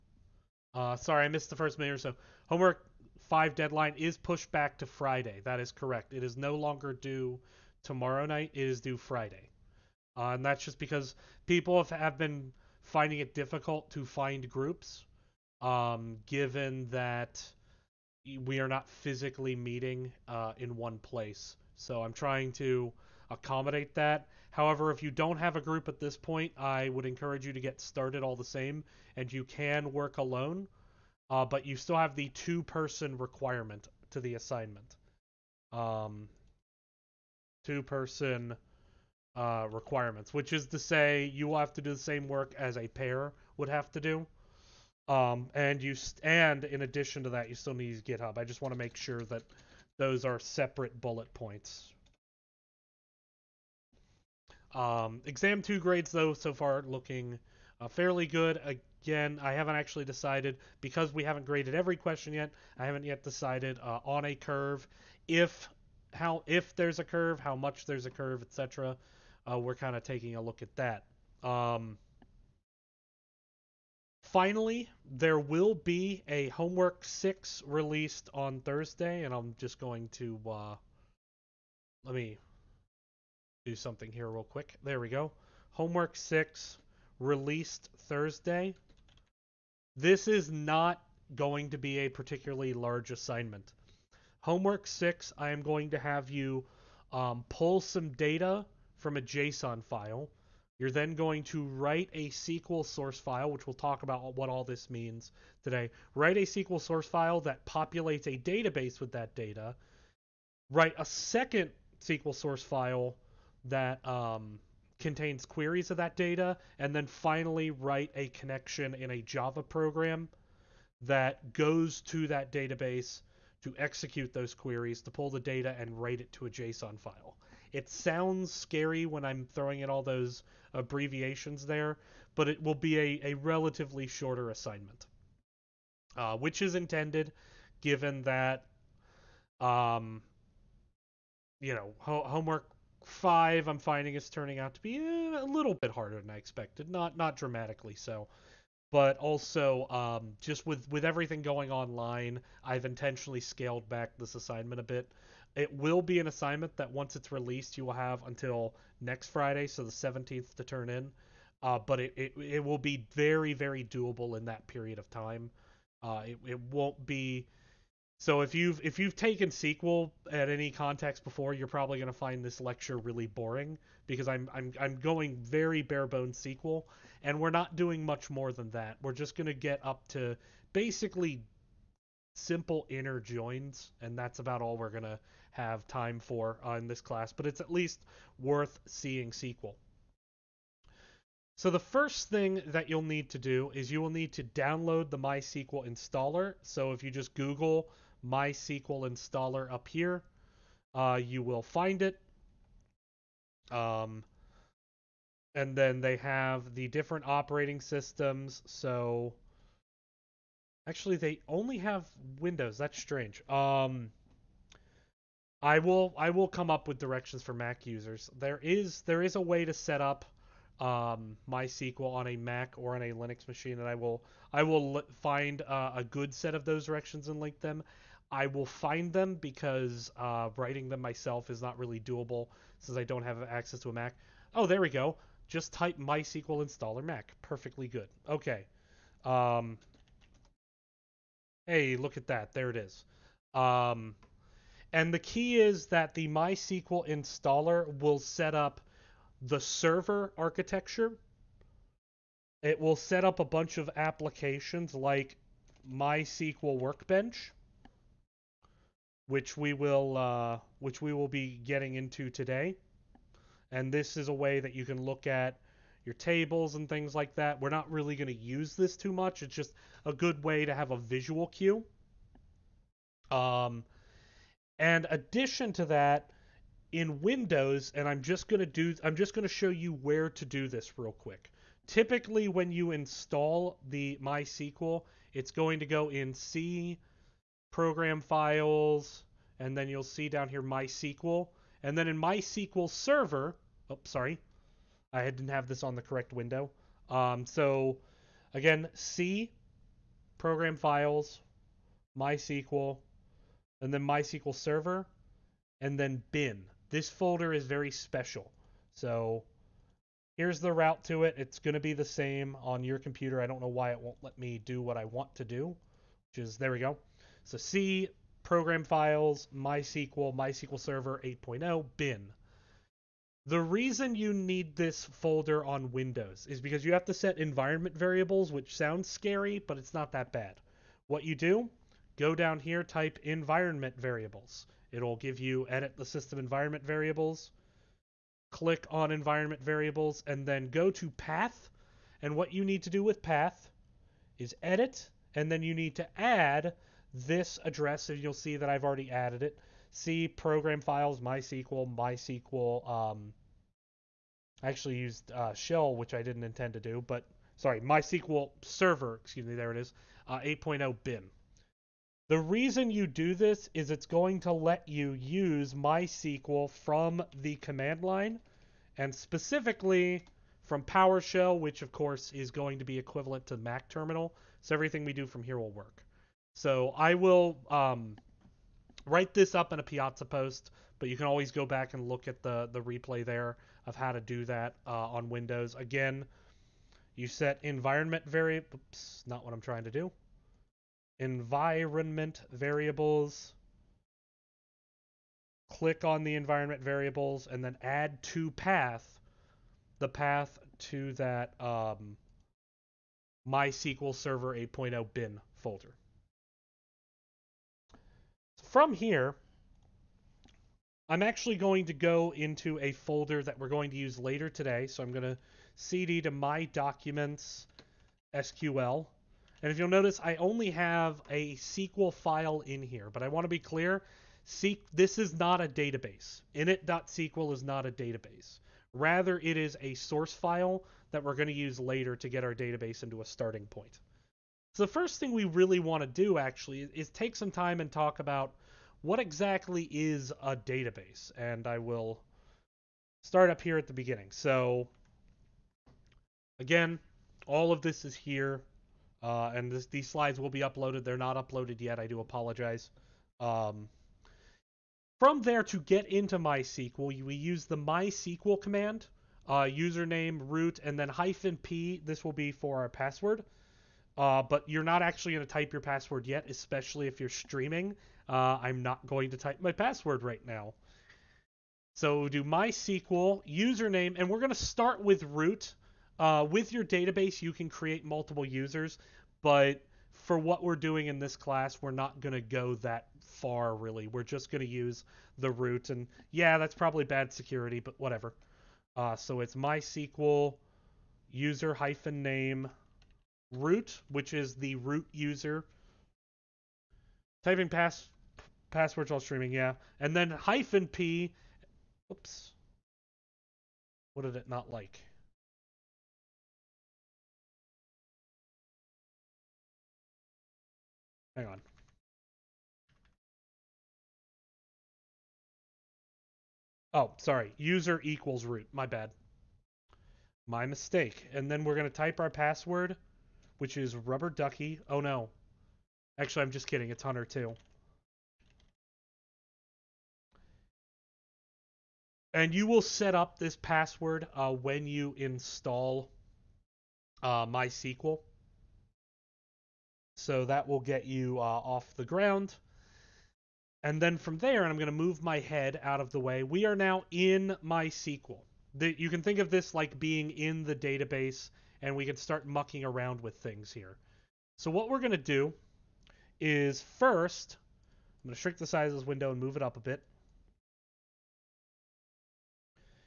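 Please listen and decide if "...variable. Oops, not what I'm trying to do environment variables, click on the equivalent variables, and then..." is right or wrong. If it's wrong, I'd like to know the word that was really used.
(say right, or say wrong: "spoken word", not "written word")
wrong: "environment", not "equivalent".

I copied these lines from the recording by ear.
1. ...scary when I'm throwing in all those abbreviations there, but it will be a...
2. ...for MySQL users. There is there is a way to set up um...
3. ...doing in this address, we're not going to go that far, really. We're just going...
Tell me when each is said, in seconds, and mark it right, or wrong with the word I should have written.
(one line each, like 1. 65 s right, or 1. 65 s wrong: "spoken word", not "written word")
1. 128 s right
2. 217 s wrong: "Mac", not "MySQL"
3. 480 s wrong: "class", not "address".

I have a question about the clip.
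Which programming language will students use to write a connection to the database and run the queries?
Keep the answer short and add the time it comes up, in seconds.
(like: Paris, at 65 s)
Java, at 118 s.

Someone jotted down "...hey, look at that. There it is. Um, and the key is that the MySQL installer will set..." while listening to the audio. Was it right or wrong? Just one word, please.
right.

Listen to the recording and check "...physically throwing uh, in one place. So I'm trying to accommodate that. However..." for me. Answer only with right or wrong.
wrong.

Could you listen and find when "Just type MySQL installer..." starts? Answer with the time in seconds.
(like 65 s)
235 s.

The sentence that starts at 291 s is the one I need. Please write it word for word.
And then in MySQL Server, oh, sorry, I didn't have this on the correct window.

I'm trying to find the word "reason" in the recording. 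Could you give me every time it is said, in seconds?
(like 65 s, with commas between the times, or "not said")
323 s, 362 s.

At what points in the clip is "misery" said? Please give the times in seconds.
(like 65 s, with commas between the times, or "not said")
not said.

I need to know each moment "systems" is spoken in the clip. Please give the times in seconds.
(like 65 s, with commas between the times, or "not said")
207 s, 336 s.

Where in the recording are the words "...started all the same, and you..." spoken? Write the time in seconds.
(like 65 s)
27 s.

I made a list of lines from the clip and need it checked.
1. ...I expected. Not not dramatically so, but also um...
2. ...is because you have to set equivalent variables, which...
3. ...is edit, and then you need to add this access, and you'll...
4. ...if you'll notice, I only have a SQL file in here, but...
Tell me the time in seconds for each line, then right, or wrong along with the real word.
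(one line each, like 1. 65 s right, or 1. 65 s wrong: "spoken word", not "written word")
1. 146 s right
2. 326 s wrong: "environment", not "equivalent"
3. 344 s wrong: "address", not "access"
4. 419 s right.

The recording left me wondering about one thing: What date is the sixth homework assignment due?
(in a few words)
the 17th.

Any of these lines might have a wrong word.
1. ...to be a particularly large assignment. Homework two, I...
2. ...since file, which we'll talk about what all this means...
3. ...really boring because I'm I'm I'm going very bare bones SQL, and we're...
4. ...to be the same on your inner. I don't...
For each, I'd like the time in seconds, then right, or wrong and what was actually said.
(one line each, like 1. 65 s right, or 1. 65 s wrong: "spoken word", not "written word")
1. 91 s wrong: "six", not "two"
2. 102 s wrong: "source", not "since"
3. 172 s right
4. 311 s wrong: "computer", not "inner".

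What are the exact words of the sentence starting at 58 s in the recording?
Again, I haven't actually decided because we haven't graded every question yet.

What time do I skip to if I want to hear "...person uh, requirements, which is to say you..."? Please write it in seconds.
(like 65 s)
37 s.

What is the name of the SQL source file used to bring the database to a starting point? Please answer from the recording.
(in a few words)
Init.sql.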